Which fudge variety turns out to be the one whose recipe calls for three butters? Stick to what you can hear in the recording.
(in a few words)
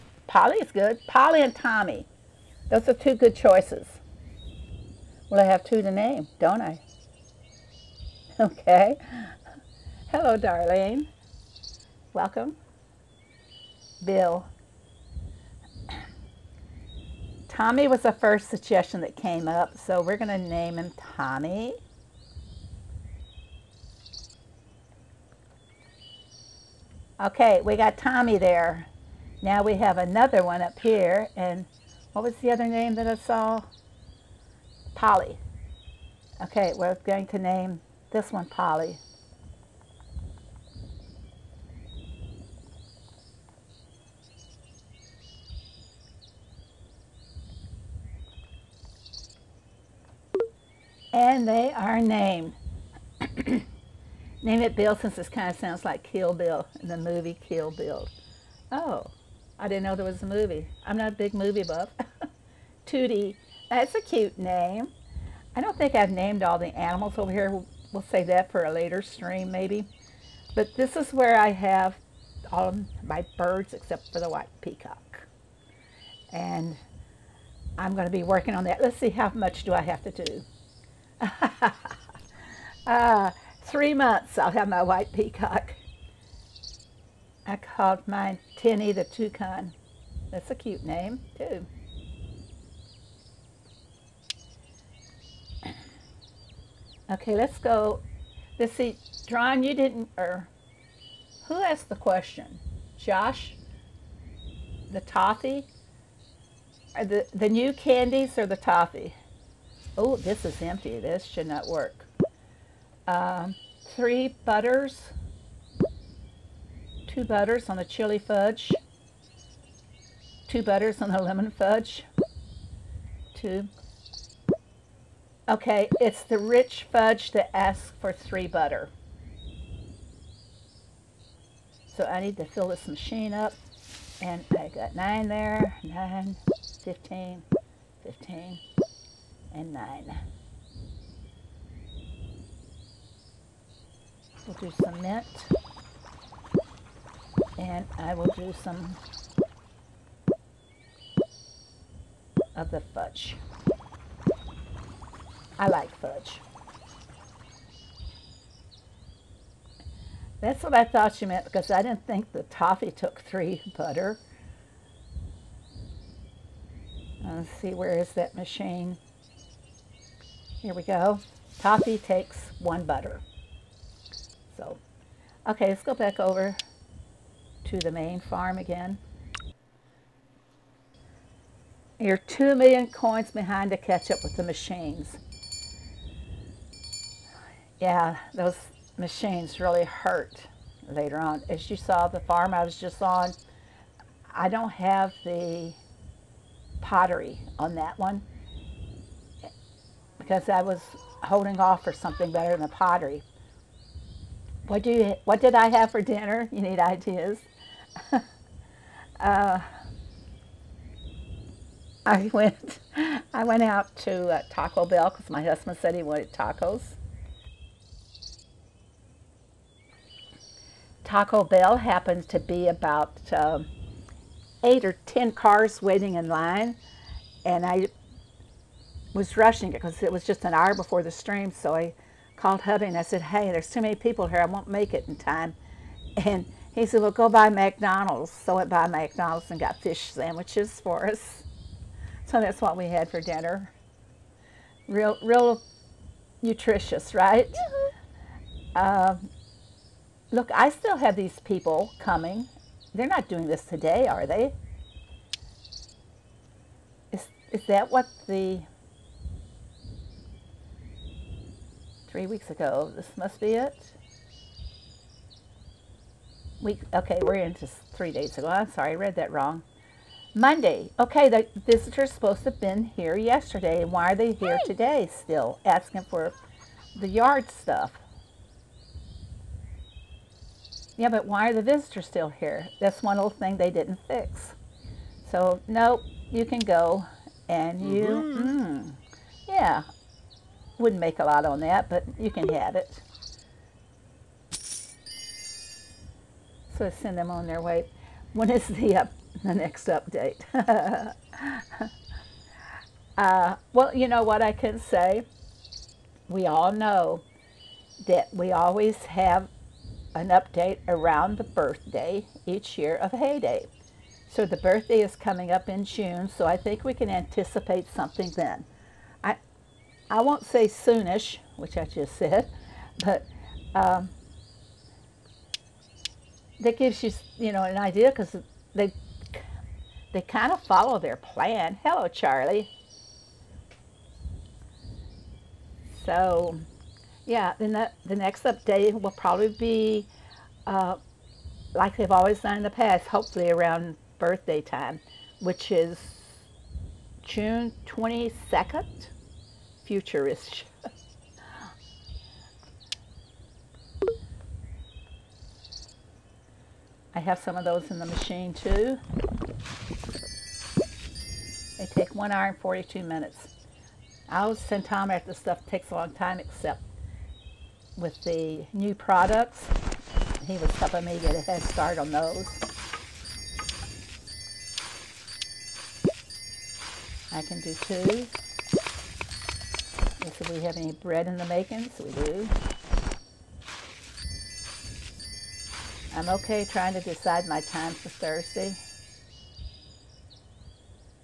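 Rich fudge.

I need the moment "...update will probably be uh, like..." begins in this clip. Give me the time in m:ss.
5:38.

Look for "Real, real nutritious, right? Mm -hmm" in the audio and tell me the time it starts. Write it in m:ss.
4:04.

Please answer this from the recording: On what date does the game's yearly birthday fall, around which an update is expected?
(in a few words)
June 22nd.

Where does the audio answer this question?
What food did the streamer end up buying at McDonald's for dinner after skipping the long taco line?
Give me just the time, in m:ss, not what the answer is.
3:59.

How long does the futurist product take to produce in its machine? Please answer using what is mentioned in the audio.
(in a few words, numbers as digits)
1 hour 42 minutes.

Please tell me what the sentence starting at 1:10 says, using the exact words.
But this is where I have all my birds except for the white peacock.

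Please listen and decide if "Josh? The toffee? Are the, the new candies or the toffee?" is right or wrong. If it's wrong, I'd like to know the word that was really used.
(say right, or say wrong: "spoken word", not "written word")
right.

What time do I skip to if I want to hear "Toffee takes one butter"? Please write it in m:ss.
2:51.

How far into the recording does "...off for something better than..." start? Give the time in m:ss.
3:21.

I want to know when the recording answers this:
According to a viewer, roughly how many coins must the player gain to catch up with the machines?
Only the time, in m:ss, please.
3:02.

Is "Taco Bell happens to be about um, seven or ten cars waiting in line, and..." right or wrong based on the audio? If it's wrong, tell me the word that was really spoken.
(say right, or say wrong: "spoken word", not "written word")
wrong: "eight", not "seven".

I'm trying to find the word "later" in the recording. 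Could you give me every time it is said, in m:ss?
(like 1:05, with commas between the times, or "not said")
1:08, 3:10.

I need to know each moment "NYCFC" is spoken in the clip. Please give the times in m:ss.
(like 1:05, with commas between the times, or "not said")
not said.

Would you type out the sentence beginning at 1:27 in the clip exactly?
I called mine Tinny the Toucan.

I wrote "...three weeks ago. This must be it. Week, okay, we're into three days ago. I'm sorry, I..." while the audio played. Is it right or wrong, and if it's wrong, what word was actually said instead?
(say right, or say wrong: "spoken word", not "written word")
right.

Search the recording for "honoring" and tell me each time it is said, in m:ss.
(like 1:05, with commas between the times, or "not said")
not said.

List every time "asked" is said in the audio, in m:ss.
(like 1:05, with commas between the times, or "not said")
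1:41.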